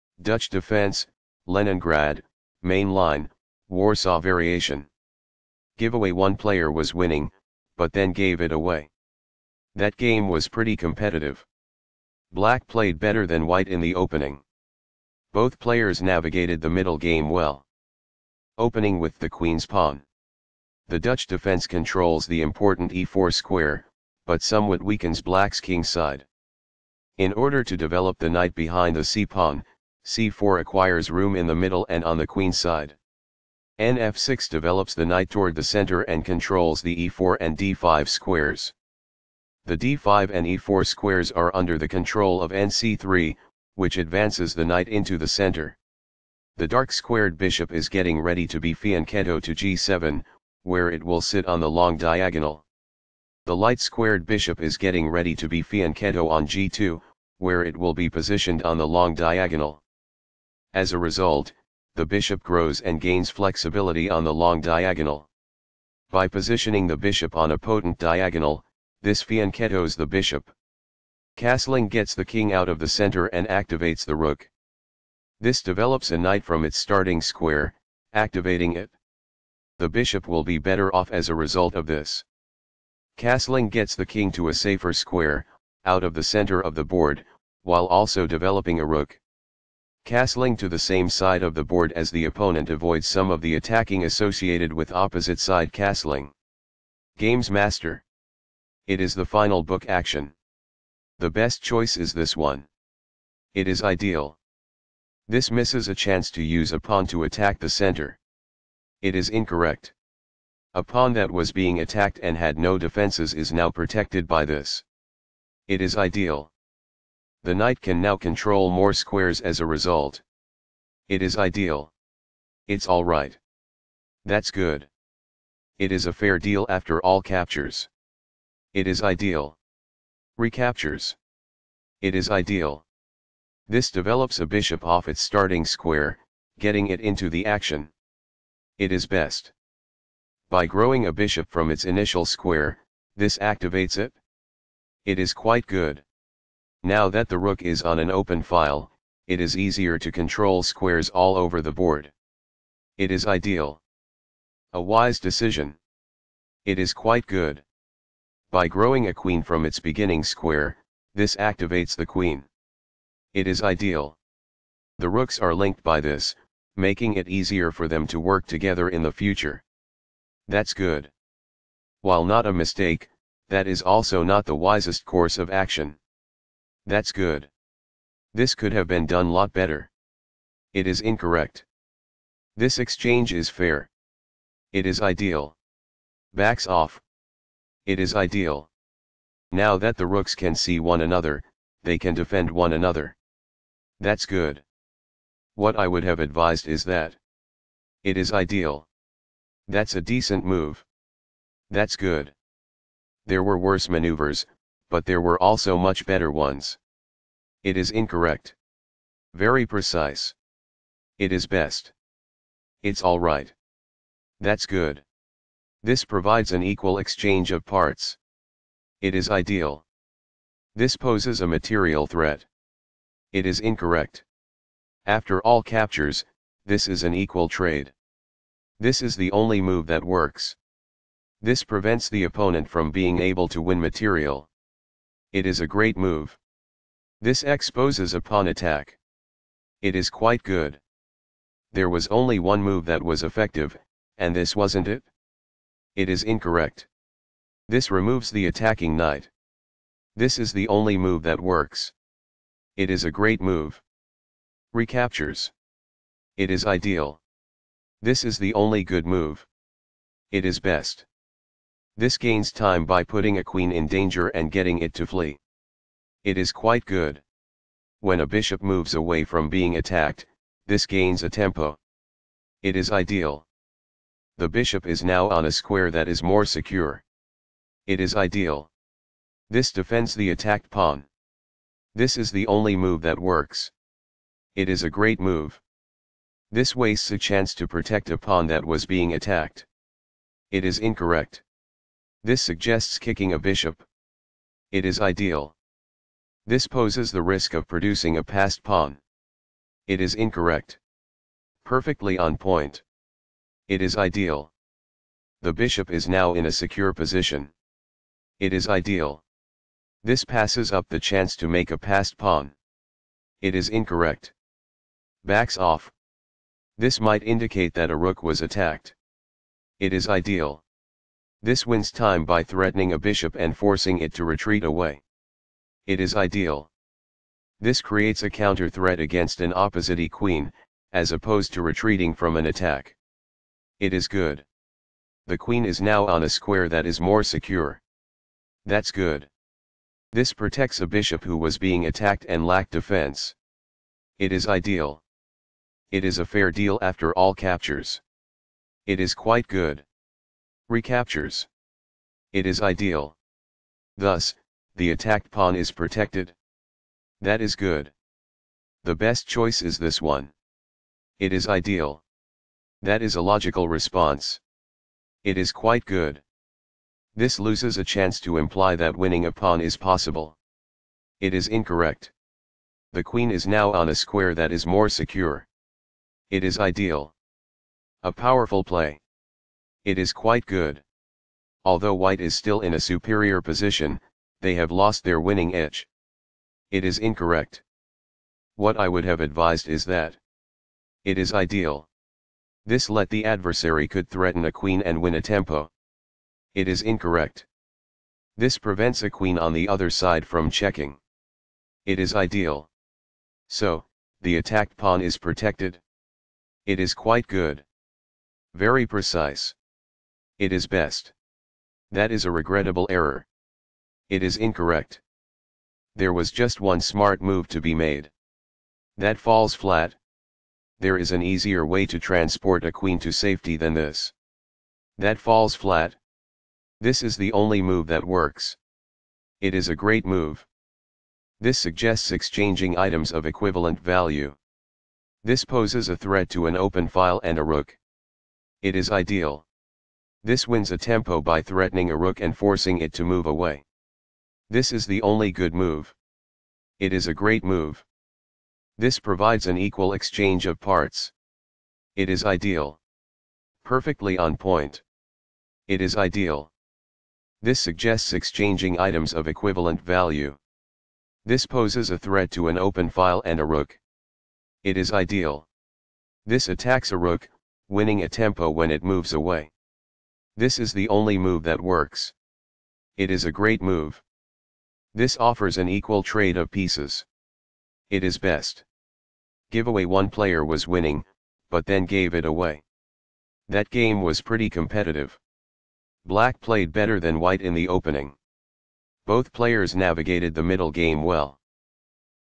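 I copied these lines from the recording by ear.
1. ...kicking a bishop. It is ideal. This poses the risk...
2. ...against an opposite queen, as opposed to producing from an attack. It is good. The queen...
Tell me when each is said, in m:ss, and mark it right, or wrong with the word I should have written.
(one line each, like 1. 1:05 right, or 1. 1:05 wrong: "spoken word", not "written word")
1. 4:52 right
2. 5:28 wrong: "retreating", not "producing".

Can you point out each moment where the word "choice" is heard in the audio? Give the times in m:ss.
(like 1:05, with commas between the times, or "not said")
1:41, 5:59.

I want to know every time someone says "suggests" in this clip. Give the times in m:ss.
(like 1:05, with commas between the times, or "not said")
4:52, 7:11, 7:37.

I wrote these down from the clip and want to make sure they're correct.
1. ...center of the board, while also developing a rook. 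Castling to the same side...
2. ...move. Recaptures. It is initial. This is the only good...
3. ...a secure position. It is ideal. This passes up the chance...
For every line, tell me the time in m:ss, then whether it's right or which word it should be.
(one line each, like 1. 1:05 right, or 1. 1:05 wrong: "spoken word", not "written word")
1. 1:26 right
2. 4:13 wrong: "ideal", not "initial"
3. 5:06 right.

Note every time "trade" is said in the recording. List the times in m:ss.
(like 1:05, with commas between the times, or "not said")
3:47, 7:56.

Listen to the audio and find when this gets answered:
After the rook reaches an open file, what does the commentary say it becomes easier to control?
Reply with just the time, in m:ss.
2:30.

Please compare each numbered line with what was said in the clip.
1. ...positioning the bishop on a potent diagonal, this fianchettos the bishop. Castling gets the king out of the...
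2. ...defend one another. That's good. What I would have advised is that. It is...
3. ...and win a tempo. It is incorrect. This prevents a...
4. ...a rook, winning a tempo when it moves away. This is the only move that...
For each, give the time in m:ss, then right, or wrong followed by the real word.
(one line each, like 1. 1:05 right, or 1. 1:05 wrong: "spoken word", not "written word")
1. 1:06 right
2. 3:12 right
3. 6:34 right
4. 7:46 right.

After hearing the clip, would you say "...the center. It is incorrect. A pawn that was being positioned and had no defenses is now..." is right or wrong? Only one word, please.
wrong.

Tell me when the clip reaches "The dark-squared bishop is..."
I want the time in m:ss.
0:46.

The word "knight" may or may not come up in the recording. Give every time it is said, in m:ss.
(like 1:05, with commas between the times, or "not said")
0:28, 0:35, 0:44, 1:16, 1:57, 4:08.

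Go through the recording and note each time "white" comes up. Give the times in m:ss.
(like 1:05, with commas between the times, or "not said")
0:13, 6:21, 8:07.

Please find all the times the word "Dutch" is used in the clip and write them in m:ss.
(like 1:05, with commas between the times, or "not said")
0:00, 0:20.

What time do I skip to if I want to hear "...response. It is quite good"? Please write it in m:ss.
6:03.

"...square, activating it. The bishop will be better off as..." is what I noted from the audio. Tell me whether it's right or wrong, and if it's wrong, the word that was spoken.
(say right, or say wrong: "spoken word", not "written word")
right.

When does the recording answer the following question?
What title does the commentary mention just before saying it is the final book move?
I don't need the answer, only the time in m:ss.
1:37.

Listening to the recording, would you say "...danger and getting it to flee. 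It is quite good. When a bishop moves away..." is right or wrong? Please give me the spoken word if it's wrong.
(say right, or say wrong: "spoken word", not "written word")
right.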